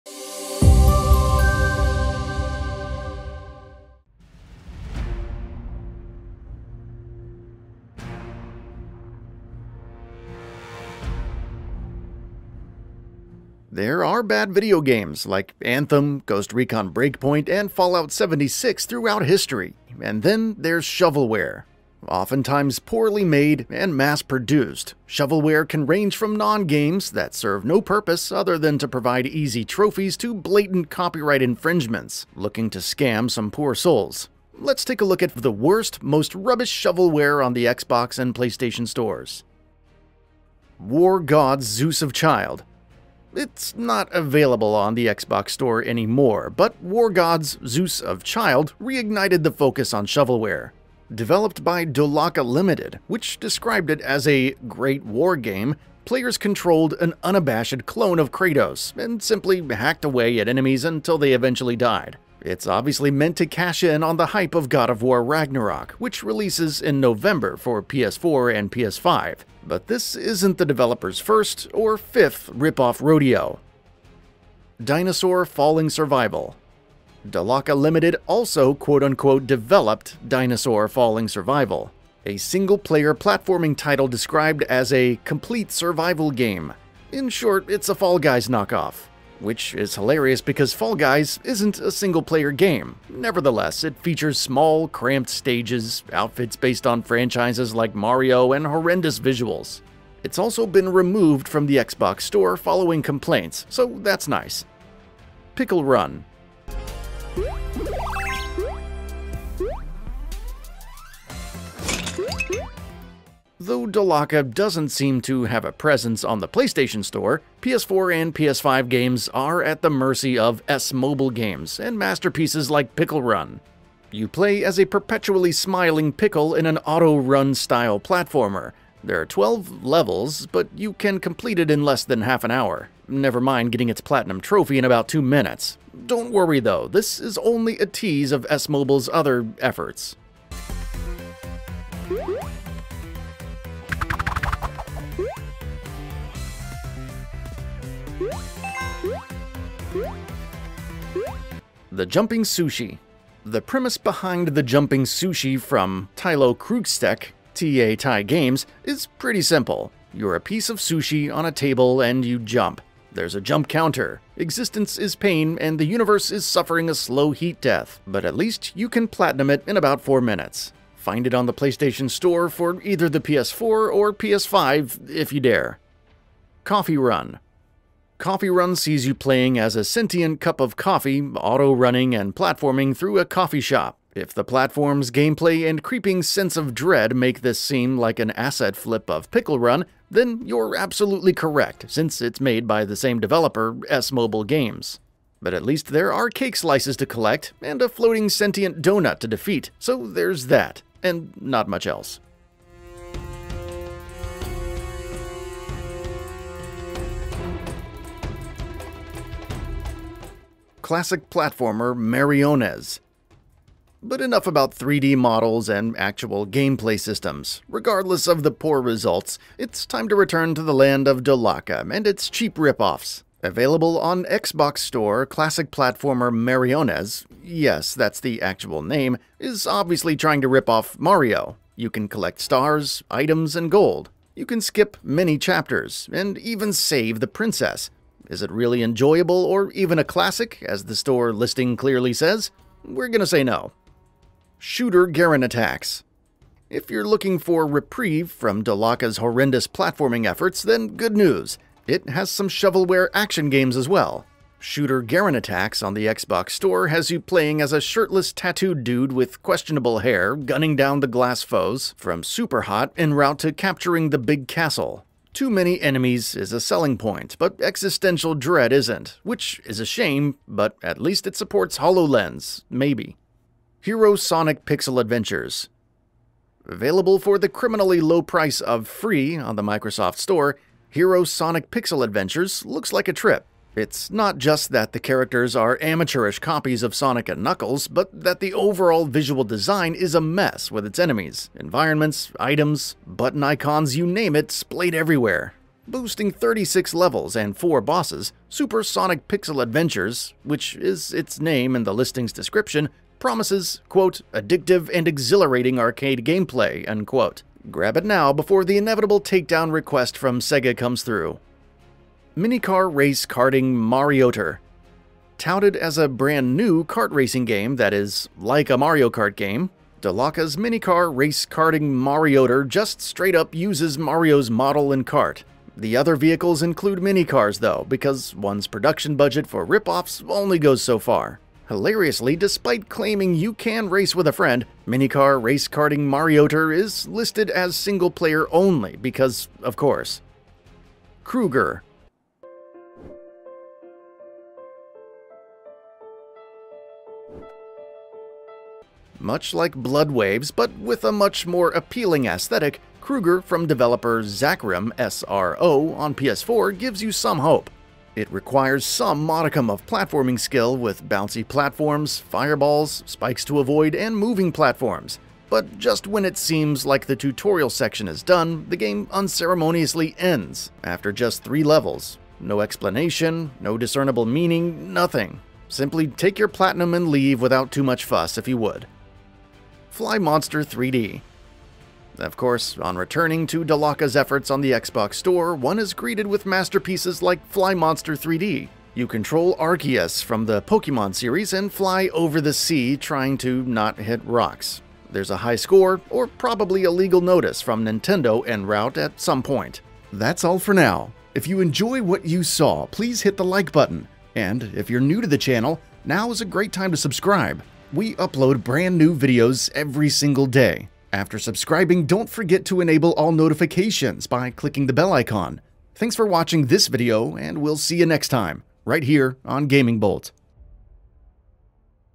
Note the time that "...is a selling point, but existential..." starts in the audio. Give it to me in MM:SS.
04:26.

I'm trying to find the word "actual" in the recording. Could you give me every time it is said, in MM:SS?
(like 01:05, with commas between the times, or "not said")
03:35, 03:48.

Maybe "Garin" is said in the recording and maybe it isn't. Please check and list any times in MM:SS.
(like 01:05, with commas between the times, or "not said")
04:05, 04:15.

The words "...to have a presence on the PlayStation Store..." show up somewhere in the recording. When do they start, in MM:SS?
01:55.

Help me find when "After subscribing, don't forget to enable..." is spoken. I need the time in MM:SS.
06:51.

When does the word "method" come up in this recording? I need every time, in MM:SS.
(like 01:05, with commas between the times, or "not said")
not said.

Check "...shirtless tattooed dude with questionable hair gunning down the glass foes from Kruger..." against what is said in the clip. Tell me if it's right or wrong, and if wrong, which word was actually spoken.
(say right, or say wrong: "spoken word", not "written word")
wrong: "Superhot", not "Kruger".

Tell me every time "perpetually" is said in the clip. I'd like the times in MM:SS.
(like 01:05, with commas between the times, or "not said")
02:04.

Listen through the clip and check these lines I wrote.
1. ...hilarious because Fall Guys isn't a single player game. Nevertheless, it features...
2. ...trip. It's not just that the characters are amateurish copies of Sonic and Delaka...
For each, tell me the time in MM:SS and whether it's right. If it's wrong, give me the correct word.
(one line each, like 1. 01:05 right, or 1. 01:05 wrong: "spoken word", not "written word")
1. 01:29 right
2. 04:43 wrong: "Knuckles", not "Delaka".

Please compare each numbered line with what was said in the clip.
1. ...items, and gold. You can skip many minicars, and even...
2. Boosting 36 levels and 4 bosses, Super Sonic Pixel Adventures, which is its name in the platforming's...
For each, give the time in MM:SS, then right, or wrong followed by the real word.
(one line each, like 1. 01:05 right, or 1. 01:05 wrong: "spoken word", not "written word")
1. 03:53 wrong: "chapters", not "minicars"
2. 04:55 wrong: "listing", not "platforming".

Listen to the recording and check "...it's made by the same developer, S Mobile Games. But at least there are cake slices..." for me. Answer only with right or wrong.
right.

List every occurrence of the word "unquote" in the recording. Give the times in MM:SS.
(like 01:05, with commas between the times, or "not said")
01:18, 05:06.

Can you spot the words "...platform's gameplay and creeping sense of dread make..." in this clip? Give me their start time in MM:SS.
03:04.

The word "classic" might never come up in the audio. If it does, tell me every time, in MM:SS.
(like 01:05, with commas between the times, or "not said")
03:30, 03:45, 04:00.